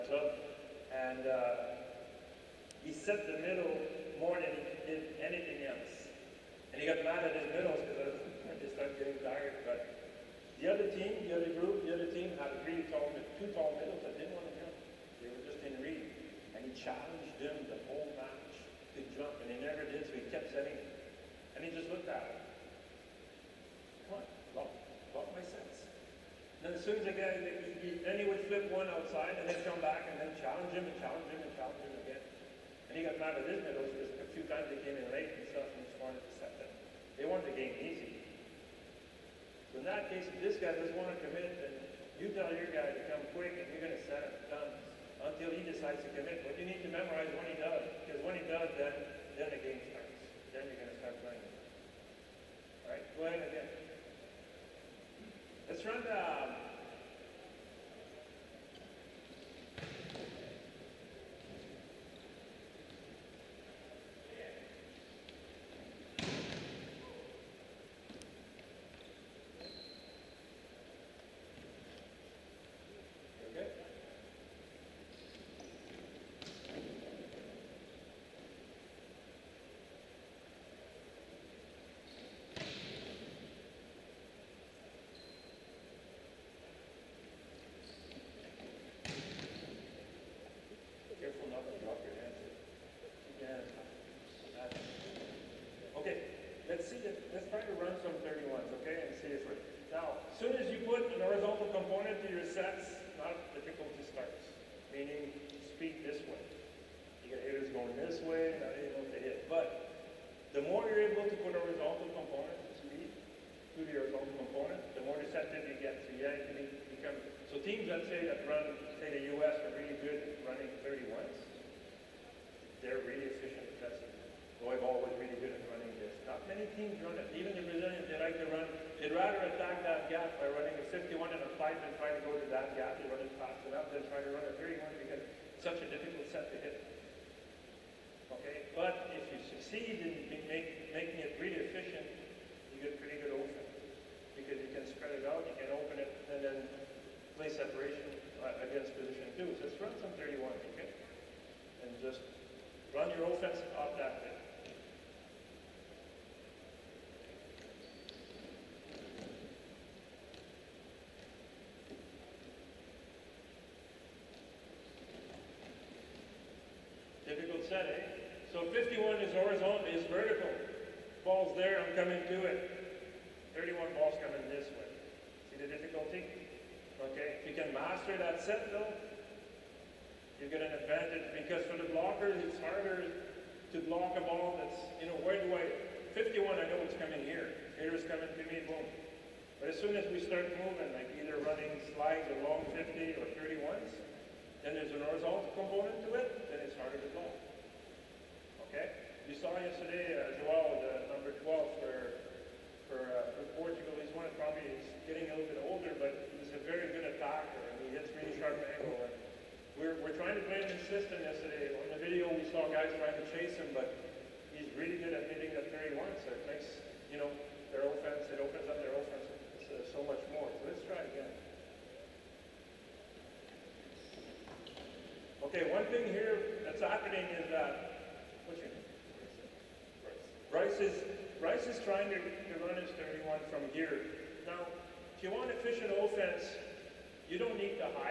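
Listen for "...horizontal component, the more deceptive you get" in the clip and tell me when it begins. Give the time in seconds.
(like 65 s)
113 s.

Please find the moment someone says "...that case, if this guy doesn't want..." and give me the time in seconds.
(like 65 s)
39 s.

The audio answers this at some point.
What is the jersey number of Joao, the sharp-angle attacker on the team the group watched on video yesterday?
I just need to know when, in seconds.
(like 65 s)
201 s.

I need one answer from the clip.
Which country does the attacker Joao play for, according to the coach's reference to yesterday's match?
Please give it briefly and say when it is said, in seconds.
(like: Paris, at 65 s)
Portugal, at 203 s.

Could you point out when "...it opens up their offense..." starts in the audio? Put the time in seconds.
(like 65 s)
218 s.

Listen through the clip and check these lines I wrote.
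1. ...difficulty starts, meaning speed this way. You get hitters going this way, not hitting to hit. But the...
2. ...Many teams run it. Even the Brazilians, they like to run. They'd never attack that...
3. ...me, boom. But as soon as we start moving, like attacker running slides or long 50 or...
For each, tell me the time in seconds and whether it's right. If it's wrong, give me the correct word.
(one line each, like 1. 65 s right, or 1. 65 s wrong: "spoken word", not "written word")
1. 103 s right
2. 126 s wrong: "rather", not "never"
3. 188 s wrong: "either", not "attacker".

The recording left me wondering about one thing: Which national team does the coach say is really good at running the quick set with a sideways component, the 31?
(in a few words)
US.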